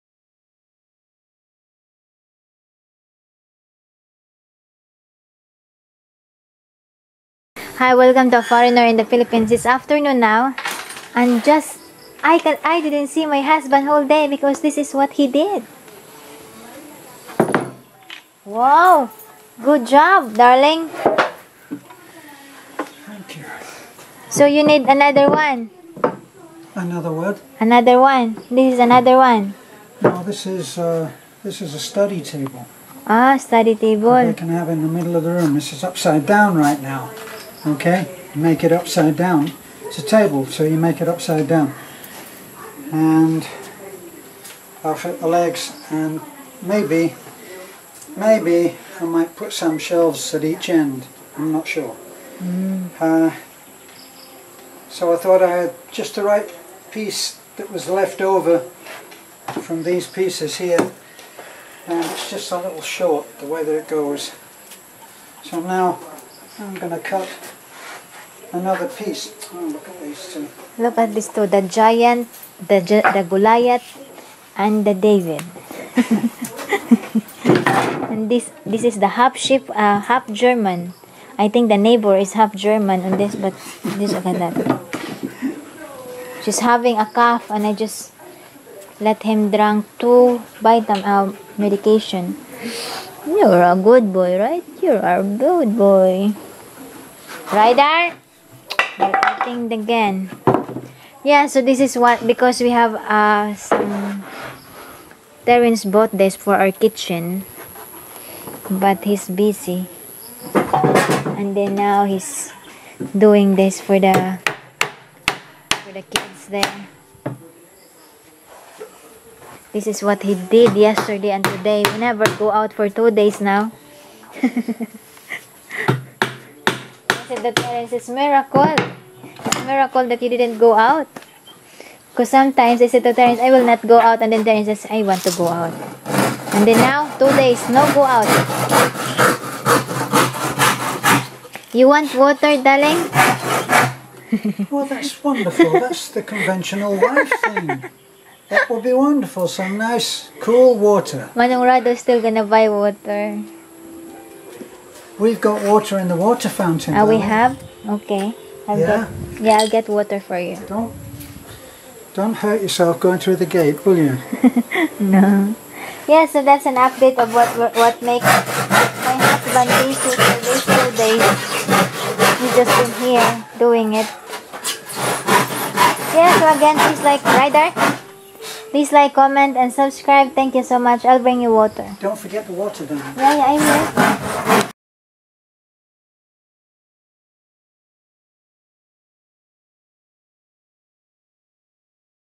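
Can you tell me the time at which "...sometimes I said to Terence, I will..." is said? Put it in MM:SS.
02:12.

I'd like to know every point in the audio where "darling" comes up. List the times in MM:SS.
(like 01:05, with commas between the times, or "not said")
00:20, 02:22.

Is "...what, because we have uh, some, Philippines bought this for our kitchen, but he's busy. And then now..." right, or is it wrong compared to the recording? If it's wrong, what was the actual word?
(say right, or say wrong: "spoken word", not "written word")
wrong: "Terence", not "Philippines".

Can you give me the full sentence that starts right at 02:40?
Don't don't hurt yourself going through the gate, will you?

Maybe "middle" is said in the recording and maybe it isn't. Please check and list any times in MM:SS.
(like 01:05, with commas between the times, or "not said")
00:34.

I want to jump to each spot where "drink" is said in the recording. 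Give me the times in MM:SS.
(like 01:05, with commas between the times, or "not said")
01:29.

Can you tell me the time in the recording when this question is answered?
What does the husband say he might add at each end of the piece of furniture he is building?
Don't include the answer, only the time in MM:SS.
00:49.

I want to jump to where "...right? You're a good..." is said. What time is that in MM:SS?
01:34.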